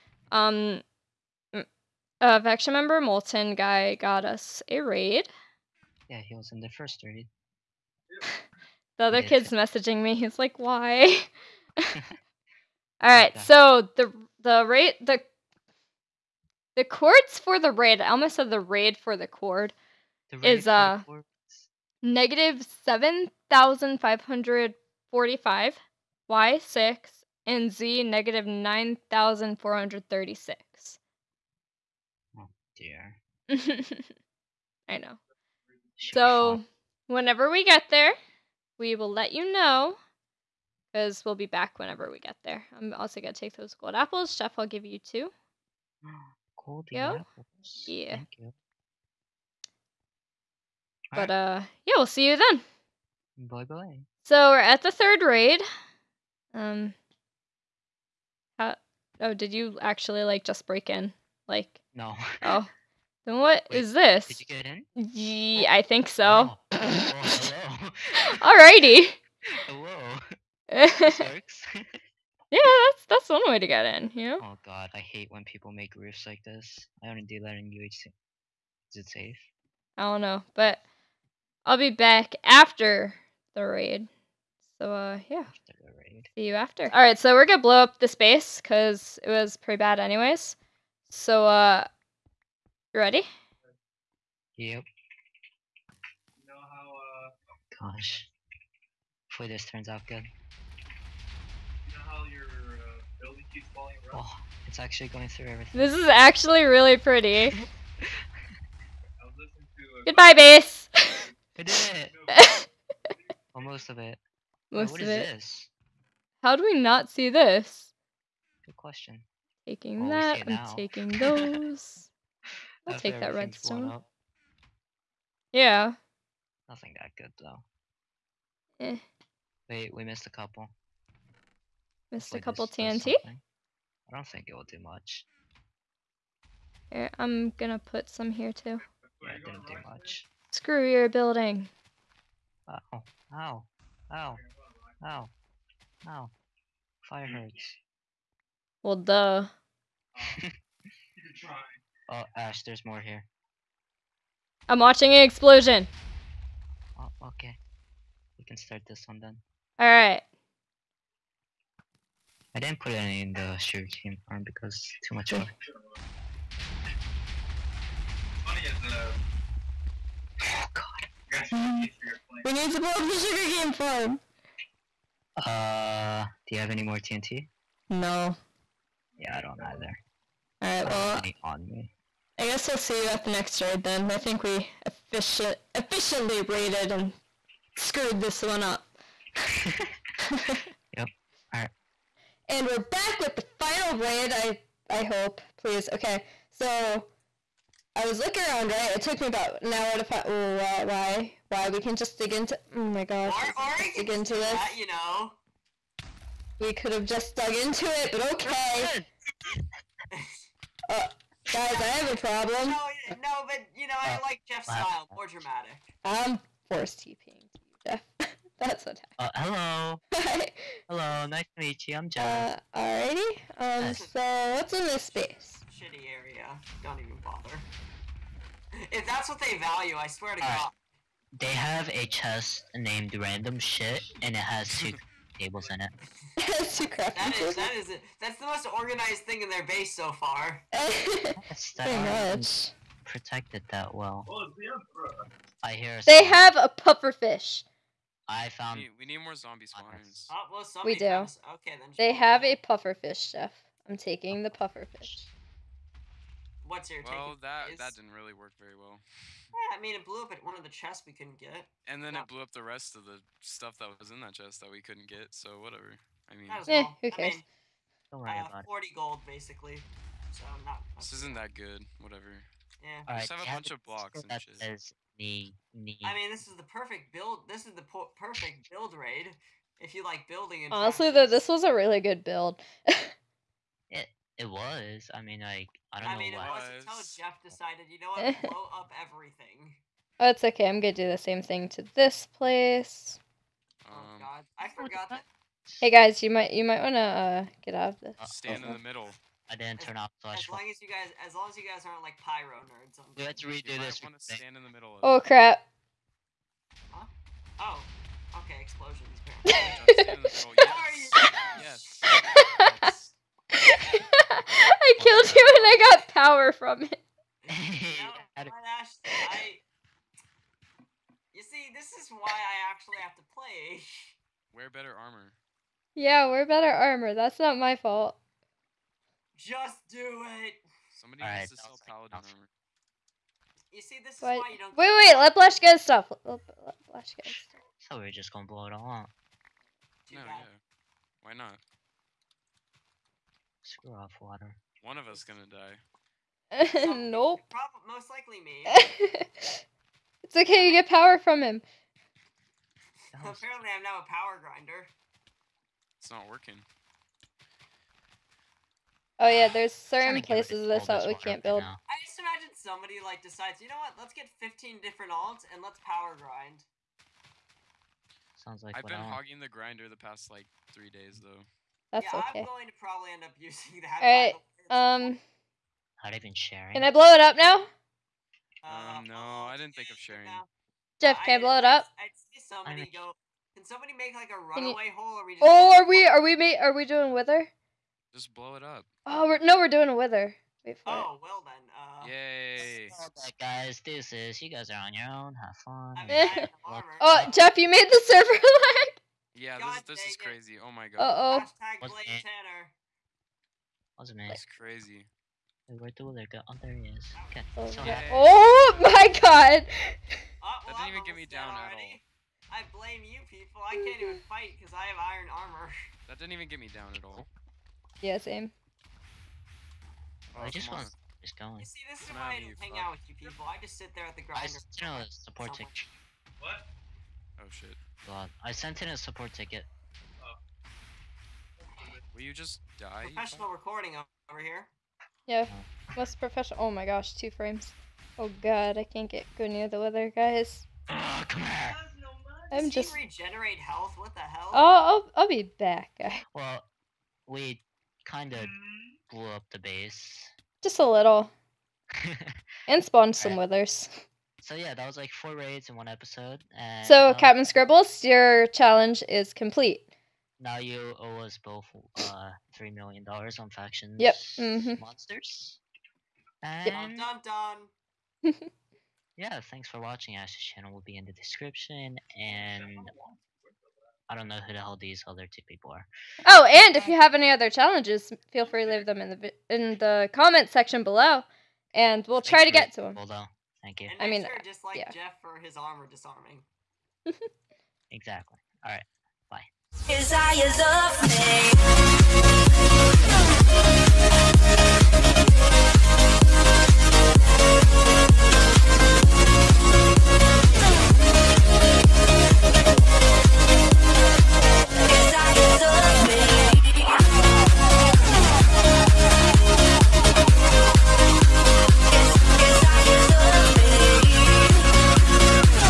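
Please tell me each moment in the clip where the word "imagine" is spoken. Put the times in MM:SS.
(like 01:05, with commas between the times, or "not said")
06:02.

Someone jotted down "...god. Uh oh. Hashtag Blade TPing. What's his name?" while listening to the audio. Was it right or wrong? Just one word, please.
wrong.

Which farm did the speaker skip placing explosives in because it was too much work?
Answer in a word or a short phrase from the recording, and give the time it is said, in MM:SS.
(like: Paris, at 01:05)
sugarcane farm, at 02:43.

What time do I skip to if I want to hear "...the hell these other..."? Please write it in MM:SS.
07:54.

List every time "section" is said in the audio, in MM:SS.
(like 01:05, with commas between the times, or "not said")
07:05, 08:00.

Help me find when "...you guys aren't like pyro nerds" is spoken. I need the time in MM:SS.
05:01.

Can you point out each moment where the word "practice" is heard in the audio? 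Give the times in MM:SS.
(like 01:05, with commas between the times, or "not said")
04:41.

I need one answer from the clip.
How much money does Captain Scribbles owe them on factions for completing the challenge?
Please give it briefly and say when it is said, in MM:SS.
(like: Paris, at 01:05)
3 million dollars, at 07:42.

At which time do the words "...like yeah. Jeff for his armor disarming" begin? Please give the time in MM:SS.
08:04.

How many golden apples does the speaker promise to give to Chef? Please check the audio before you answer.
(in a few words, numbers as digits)
2.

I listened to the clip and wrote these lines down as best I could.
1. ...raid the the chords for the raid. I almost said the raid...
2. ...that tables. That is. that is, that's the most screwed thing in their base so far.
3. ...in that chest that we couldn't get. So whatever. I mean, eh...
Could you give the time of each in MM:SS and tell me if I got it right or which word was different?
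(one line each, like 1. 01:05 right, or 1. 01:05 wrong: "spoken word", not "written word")
1. 00:14 right
2. 03:57 wrong: "organized", not "screwed"
3. 04:24 right.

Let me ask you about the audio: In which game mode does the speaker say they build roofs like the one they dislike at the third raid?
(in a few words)
UHC.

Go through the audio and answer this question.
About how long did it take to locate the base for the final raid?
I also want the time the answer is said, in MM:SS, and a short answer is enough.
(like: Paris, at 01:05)
about an hour, at 03:19.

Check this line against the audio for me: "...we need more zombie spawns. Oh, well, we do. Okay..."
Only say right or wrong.
right.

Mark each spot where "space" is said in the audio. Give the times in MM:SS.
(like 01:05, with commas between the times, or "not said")
01:28, 03:45.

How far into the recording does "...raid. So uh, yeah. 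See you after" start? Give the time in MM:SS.
01:23.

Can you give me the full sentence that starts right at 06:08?
Sounds like I've been hogging the grinder the past like three days though.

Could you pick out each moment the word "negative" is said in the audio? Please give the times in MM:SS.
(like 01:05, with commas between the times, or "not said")
00:22, 00:28.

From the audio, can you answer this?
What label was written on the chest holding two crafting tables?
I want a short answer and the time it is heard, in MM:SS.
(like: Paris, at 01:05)
random shit, at 03:53.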